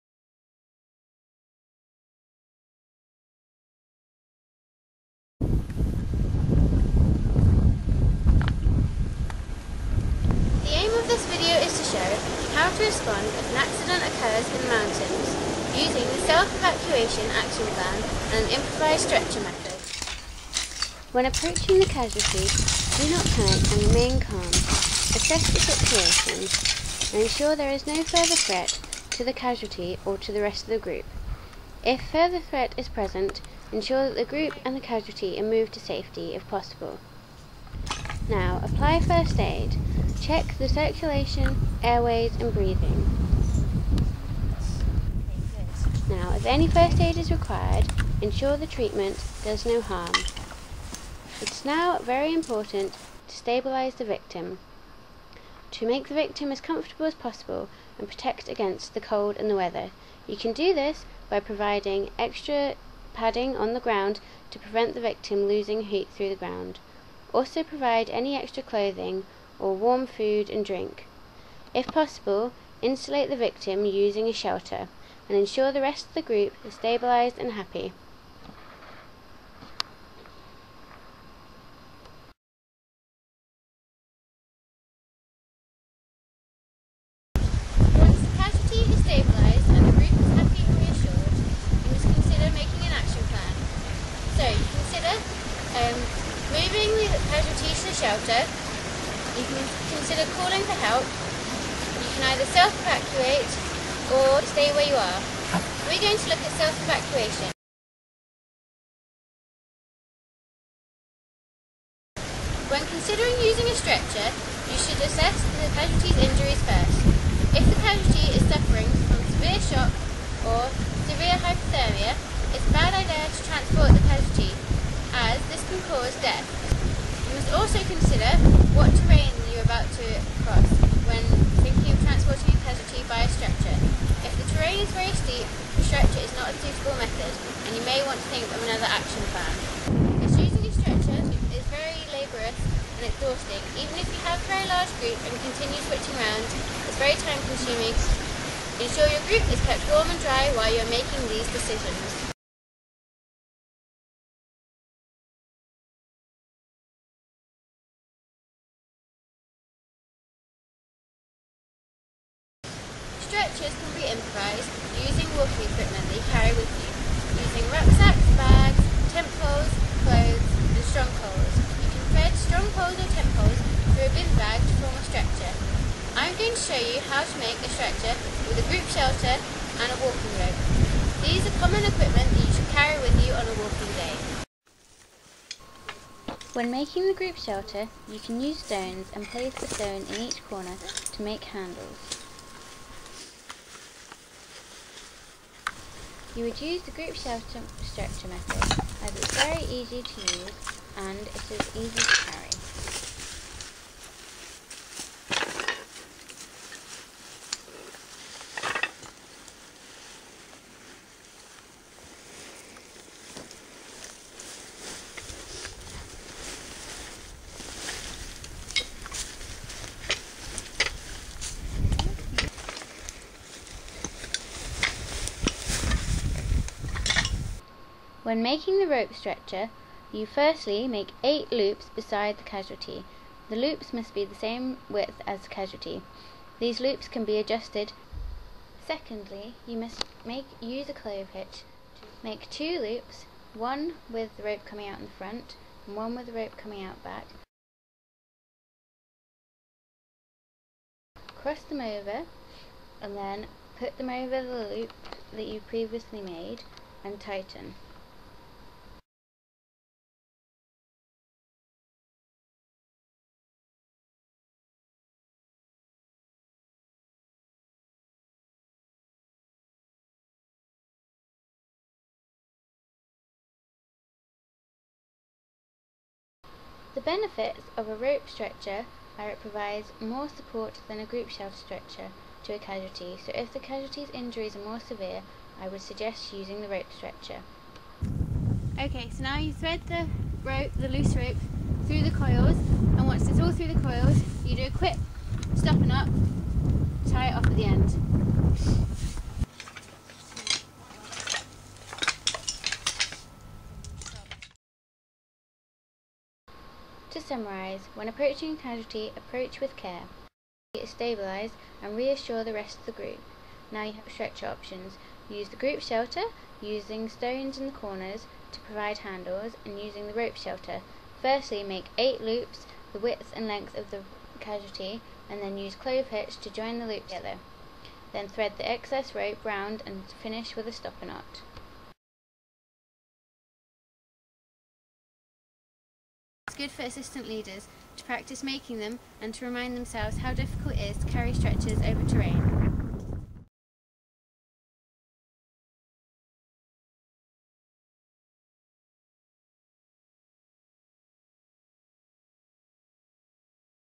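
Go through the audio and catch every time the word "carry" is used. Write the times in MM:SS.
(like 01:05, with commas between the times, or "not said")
02:46, 03:02, 03:22, 05:41.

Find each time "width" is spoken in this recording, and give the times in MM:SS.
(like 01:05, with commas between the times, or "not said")
03:54, 05:22.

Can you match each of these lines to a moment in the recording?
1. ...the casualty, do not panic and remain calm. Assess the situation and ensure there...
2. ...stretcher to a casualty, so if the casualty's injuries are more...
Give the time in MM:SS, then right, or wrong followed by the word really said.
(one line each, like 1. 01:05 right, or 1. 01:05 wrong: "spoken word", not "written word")
1. 00:21 right
2. 04:41 right.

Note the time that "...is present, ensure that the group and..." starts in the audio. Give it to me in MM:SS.
00:32.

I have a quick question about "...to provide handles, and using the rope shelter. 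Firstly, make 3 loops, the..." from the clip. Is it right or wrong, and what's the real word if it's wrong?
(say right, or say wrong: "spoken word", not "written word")
wrong: "8", not "3".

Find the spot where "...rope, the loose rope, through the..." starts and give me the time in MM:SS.
04:50.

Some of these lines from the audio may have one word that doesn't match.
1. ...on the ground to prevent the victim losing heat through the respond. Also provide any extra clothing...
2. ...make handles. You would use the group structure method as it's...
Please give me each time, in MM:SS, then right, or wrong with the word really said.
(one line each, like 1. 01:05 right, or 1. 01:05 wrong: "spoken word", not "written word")
1. 01:03 wrong: "ground", not "respond"
2. 03:11 right.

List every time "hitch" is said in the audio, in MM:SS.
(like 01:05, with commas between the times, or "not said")
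04:01, 05:26.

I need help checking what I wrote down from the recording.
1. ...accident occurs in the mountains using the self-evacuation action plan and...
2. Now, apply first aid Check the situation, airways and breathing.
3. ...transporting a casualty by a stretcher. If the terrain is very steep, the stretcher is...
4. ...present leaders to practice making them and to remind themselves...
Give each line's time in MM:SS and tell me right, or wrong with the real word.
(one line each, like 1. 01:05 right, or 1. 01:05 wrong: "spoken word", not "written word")
1. 00:13 right
2. 00:38 wrong: "circulation", not "situation"
3. 02:12 right
4. 05:36 wrong: "assistant", not "present".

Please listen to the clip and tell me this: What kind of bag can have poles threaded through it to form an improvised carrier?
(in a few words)
Bin bag.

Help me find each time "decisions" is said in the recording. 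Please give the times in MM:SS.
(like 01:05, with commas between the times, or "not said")
02:31.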